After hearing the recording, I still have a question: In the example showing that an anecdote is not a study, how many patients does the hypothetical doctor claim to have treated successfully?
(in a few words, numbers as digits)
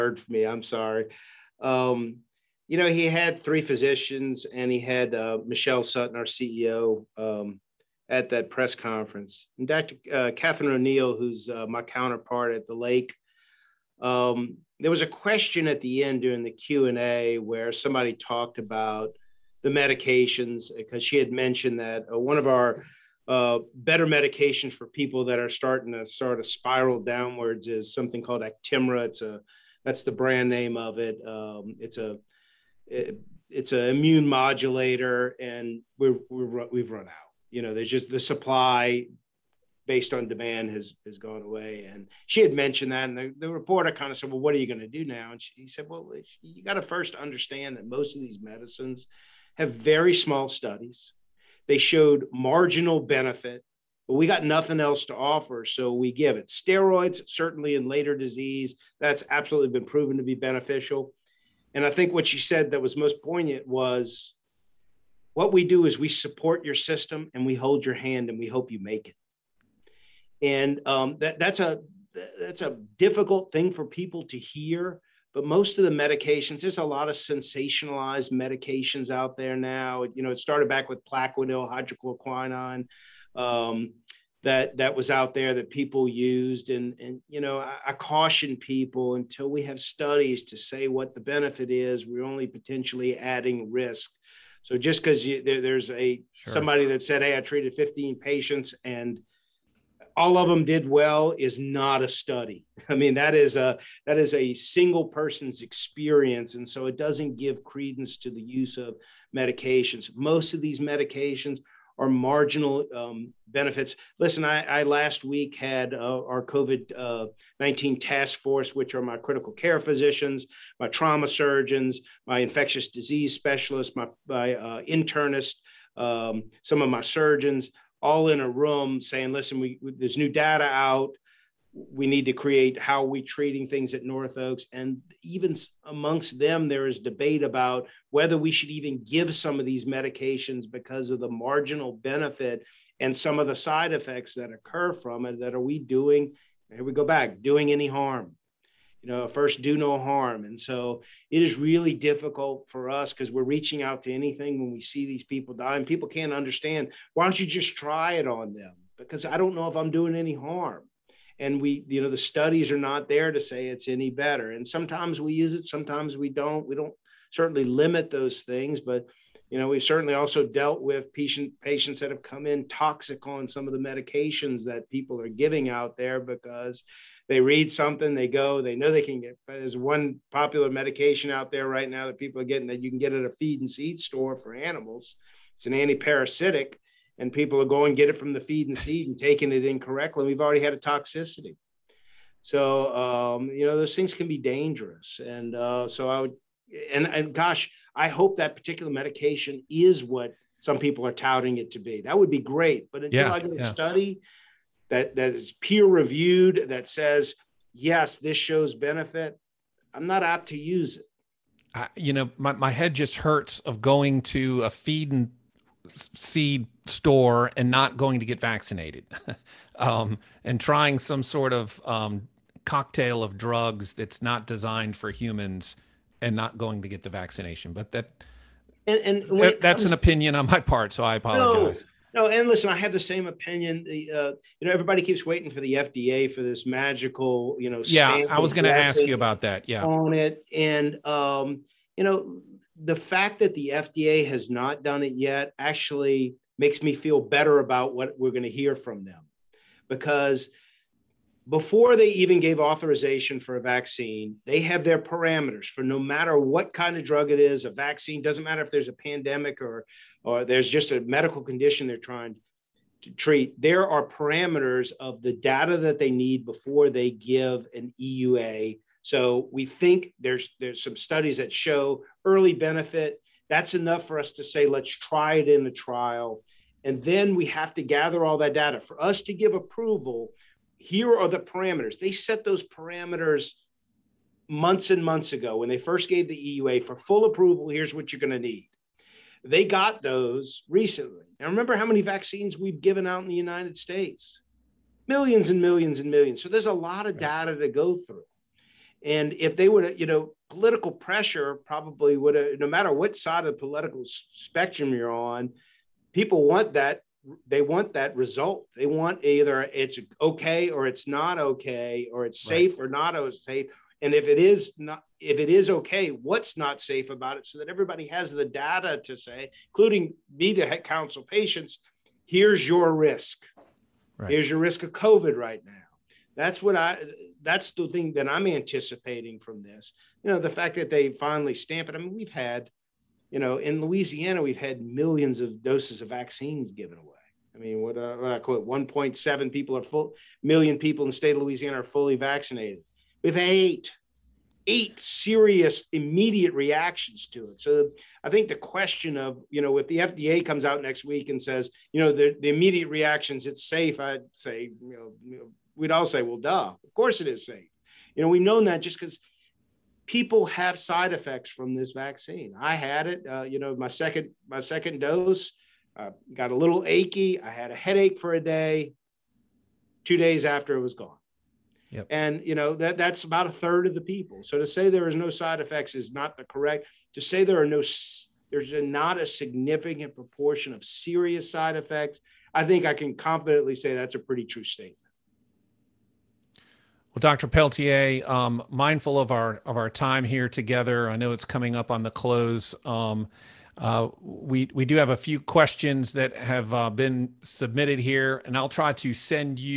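15.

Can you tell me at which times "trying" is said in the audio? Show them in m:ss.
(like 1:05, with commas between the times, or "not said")
3:40, 4:21.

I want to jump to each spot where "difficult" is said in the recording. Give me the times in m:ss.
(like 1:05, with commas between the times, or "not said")
1:12, 2:31.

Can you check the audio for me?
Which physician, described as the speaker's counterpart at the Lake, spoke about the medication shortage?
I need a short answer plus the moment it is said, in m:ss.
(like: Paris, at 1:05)
Catherine O'Neal, at 0:10.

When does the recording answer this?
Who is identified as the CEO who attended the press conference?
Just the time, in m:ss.
0:05.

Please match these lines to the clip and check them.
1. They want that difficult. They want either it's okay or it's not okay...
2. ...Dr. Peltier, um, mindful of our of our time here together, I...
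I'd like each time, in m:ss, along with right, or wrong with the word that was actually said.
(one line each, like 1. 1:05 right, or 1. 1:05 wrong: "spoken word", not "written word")
1. 5:07 wrong: "result", not "difficult"
2. 6:27 right.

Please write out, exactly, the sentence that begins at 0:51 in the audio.
They showed marginal benefit, but we got nothing else to offer.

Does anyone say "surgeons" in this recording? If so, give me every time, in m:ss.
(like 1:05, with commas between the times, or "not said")
2:01, 2:06.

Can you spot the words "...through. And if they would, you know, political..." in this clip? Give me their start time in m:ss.
4:57.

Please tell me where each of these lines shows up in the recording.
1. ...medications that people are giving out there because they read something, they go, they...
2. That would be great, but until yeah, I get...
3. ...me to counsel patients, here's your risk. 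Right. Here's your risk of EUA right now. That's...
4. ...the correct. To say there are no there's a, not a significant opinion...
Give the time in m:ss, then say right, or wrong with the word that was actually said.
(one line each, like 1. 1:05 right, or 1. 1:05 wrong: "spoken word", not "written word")
1. 2:53 right
2. 3:22 right
3. 5:20 wrong: "COVID", not "EUA"
4. 6:16 wrong: "proportion", not "opinion".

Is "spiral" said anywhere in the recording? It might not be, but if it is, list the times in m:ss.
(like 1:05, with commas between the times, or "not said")
0:26.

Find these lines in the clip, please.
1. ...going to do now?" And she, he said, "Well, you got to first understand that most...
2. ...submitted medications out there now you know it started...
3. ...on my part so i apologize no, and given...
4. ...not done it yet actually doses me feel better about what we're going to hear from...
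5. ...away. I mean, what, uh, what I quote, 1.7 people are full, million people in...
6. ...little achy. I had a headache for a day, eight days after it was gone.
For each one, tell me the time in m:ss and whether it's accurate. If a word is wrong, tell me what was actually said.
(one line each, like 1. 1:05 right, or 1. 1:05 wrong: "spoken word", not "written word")
1. 0:44 right
2. 1:17 wrong: "sensationalized", not "submitted"
3. 3:50 wrong: "listen", not "given"
4. 4:04 wrong: "makes", not "doses"
5. 5:36 right
6. 6:06 wrong: "two", not "eight".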